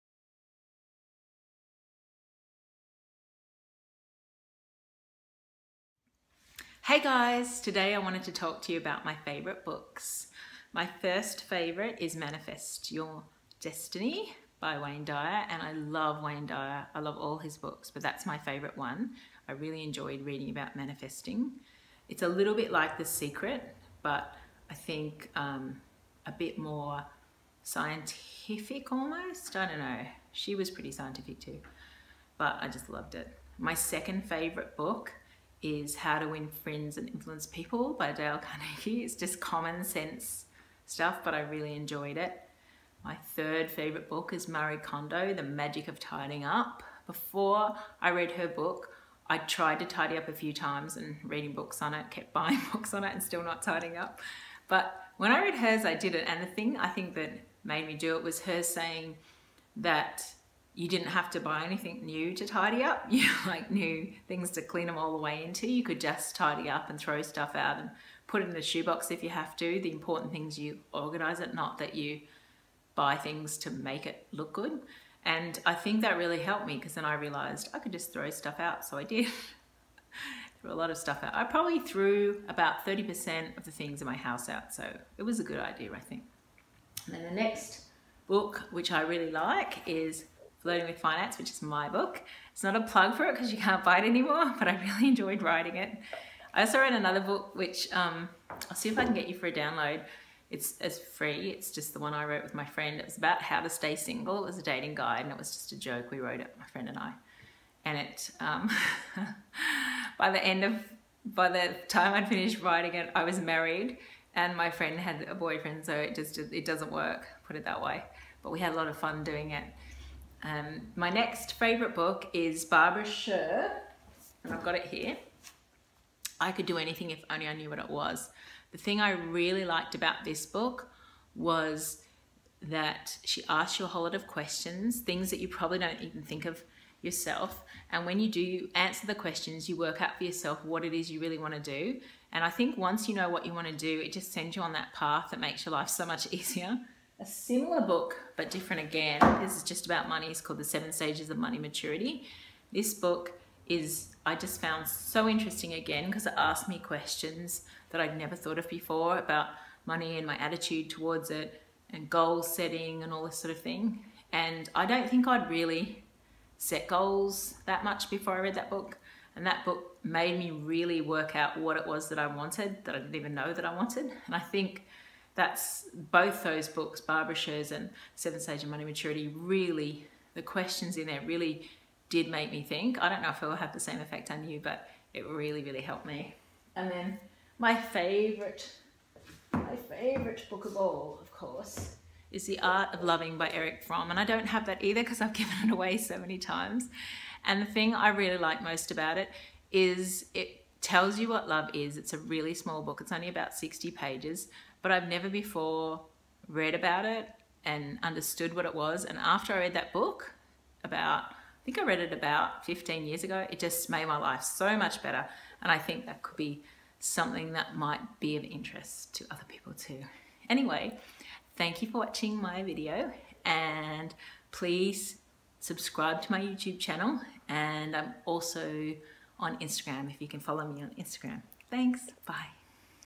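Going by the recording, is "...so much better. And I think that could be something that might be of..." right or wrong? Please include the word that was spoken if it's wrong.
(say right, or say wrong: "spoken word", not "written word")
right.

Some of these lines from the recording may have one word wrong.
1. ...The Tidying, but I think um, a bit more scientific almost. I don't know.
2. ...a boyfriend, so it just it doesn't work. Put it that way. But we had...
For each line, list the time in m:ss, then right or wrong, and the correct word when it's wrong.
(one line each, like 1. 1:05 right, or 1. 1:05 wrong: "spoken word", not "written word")
1. 0:22 wrong: "Secret", not "Tidying"
2. 1:55 right.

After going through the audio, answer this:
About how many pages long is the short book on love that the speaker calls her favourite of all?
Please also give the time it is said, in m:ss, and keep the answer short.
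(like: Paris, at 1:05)
60, at 3:23.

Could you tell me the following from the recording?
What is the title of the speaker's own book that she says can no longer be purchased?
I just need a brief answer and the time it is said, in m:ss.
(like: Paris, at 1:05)
Flirting with Finance, at 1:30.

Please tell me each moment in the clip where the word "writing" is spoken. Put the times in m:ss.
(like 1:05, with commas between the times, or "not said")
1:35, 1:52.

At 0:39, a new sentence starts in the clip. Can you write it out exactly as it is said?
It's just common sense stuff, but I really enjoyed it.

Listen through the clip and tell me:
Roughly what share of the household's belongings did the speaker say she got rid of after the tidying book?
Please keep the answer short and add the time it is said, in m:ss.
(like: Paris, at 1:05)
30%, at 1:22.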